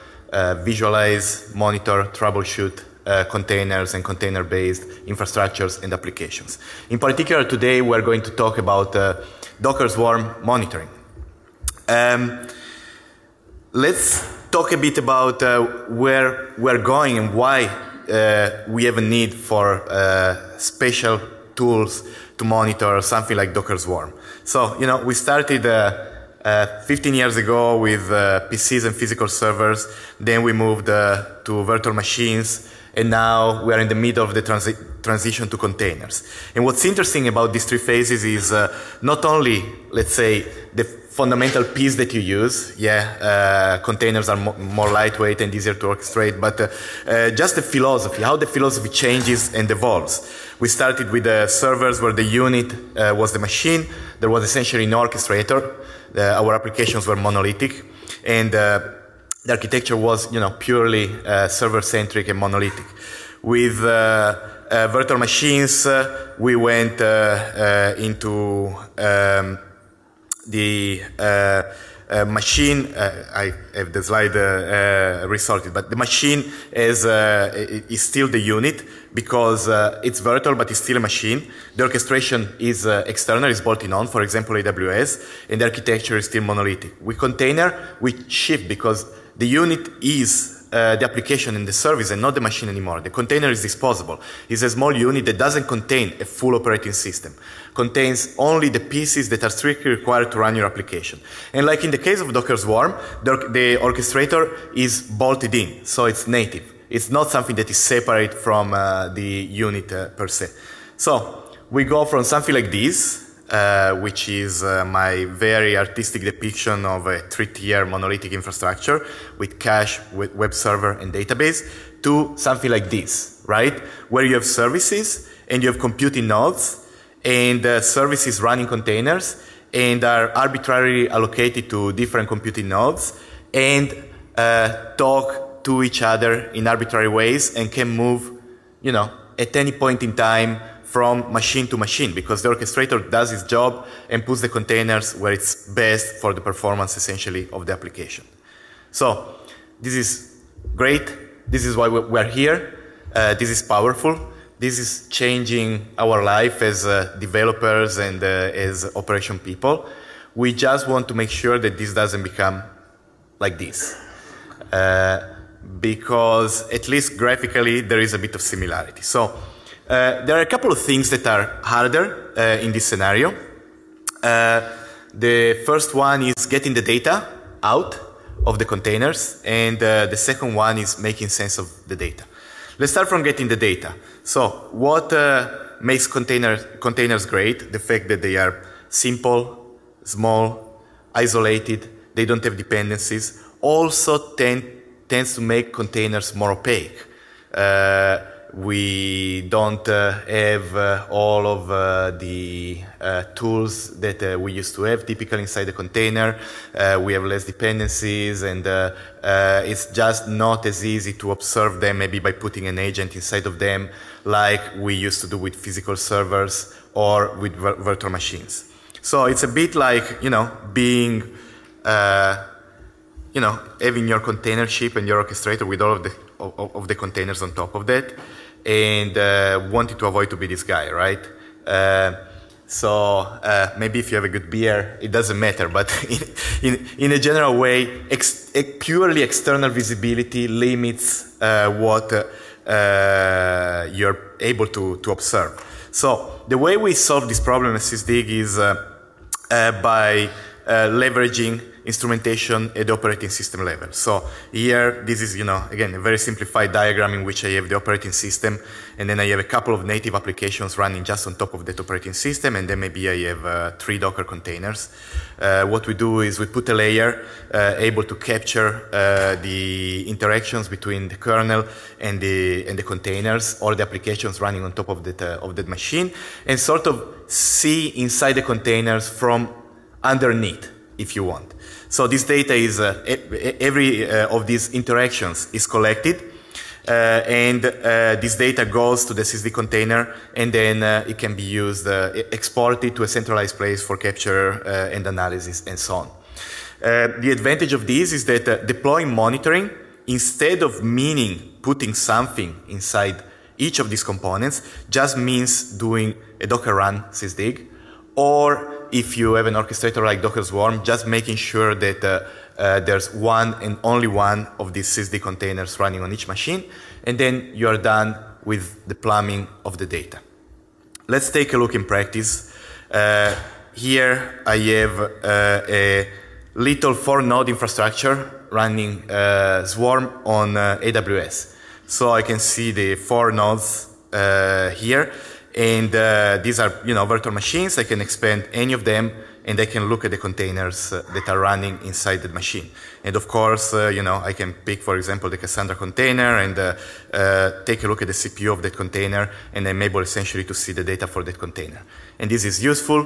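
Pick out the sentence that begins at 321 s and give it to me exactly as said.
Let's take a look in practice.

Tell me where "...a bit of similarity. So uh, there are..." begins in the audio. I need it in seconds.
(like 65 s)
168 s.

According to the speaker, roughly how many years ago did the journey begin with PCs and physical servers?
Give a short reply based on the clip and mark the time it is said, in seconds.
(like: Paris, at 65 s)
15, at 26 s.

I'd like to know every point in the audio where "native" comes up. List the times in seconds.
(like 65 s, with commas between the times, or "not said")
106 s, 259 s.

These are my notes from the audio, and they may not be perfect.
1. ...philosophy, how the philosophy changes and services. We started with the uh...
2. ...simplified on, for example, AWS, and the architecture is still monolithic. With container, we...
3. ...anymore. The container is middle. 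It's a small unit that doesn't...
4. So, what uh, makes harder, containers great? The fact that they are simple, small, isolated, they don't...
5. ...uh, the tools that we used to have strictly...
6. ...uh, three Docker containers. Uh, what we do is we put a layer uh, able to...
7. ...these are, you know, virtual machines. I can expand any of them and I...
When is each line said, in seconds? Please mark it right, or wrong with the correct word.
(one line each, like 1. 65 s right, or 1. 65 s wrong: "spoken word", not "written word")
1. 47 s wrong: "evolves", not "services"
2. 83 s wrong: "bolted", not "simplified"
3. 92 s wrong: "disposable", not "middle"
4. 184 s wrong: "container", not "harder"
5. 201 s wrong: "typically", not "strictly"
6. 263 s right
7. 336 s right.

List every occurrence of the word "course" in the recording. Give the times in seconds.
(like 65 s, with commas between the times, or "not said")
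343 s.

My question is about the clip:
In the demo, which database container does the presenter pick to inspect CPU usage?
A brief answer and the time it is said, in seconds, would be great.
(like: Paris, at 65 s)
Cassandra, at 345 s.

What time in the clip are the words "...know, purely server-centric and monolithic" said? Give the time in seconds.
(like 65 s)
60 s.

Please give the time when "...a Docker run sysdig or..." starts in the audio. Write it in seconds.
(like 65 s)
306 s.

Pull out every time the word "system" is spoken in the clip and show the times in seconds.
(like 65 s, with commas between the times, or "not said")
96 s, 253 s, 258 s, 262 s.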